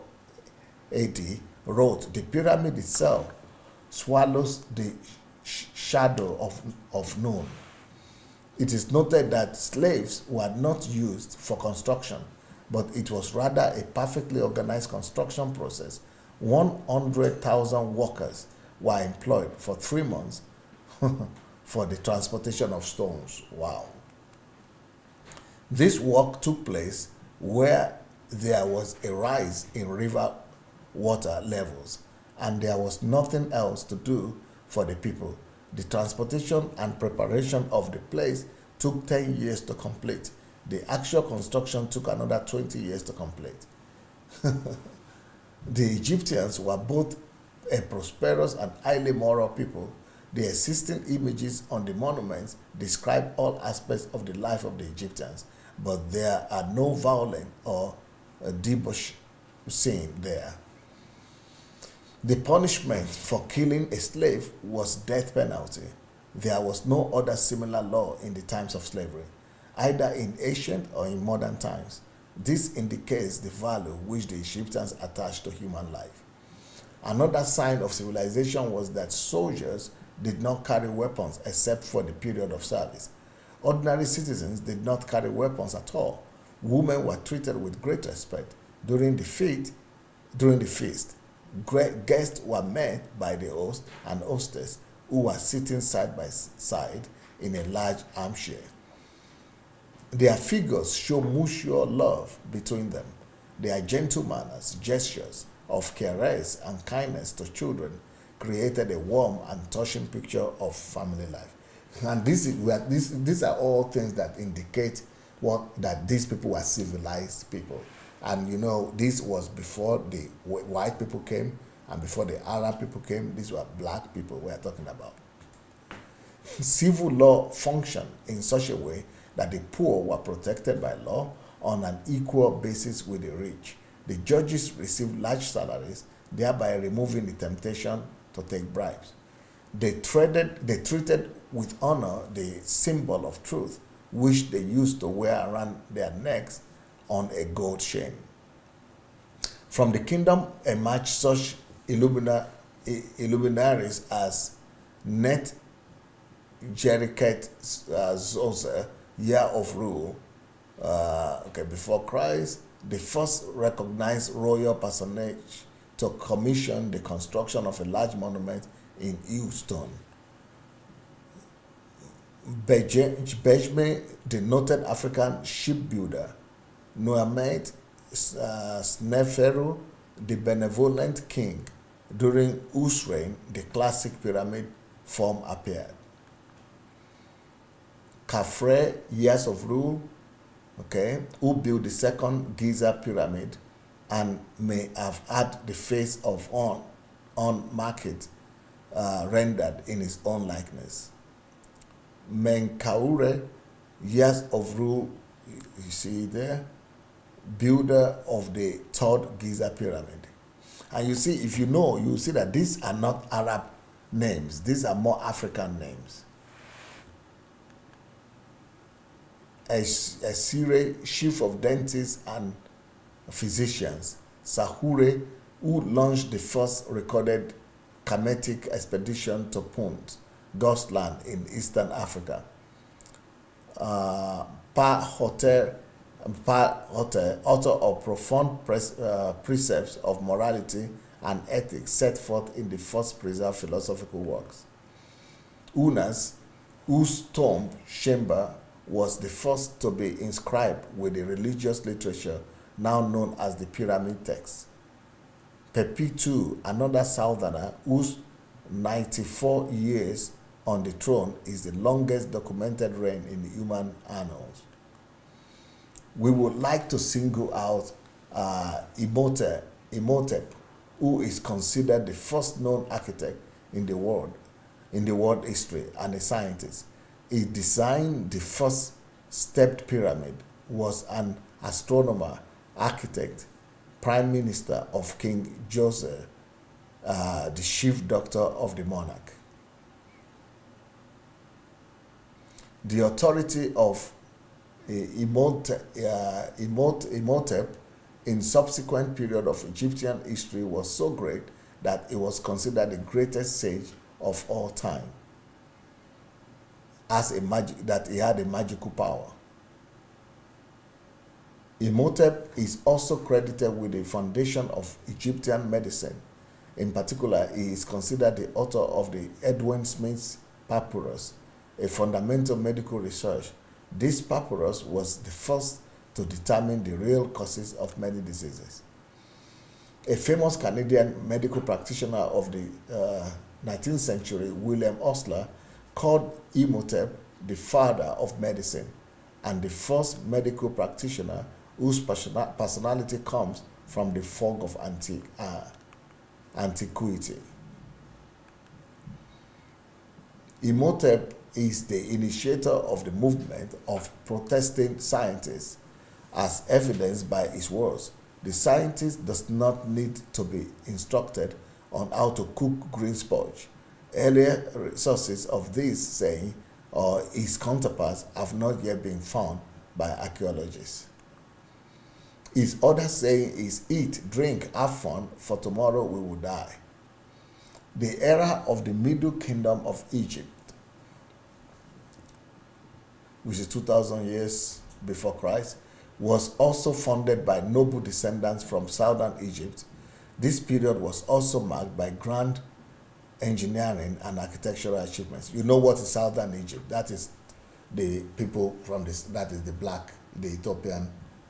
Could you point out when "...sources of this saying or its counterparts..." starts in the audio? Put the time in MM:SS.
06:04.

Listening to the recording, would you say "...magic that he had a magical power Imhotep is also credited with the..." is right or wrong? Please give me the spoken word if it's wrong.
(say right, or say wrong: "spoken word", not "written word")
right.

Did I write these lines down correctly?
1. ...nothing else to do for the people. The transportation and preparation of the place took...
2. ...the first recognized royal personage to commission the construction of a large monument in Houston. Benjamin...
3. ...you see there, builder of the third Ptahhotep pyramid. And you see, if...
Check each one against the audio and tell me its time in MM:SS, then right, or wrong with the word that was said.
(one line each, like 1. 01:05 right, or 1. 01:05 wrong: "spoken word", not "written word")
1. 00:33 right
2. 02:42 right
3. 03:25 wrong: "Giza", not "Ptahhotep".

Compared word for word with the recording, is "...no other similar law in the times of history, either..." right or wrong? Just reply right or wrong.
wrong.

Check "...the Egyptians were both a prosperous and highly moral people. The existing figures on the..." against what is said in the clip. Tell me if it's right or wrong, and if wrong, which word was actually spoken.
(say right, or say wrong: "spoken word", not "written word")
wrong: "images", not "figures".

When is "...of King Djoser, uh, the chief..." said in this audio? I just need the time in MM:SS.
04:44.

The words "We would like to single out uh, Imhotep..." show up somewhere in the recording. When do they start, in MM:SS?
04:26.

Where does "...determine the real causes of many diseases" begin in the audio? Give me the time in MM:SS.
05:26.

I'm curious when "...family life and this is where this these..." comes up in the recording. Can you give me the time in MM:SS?
01:50.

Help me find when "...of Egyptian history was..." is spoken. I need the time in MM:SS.
04:59.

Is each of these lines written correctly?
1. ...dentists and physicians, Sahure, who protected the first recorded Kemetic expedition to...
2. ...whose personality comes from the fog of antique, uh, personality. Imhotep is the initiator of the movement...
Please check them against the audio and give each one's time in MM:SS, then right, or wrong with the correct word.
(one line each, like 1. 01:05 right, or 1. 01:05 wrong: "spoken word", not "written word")
1. 03:41 wrong: "launched", not "protected"
2. 05:41 wrong: "antiquity", not "personality".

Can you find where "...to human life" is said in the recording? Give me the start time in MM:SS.
01:15.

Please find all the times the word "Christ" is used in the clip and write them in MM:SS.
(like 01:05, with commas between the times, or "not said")
02:42, 06:25.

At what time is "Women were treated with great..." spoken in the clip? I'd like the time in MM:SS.
01:26.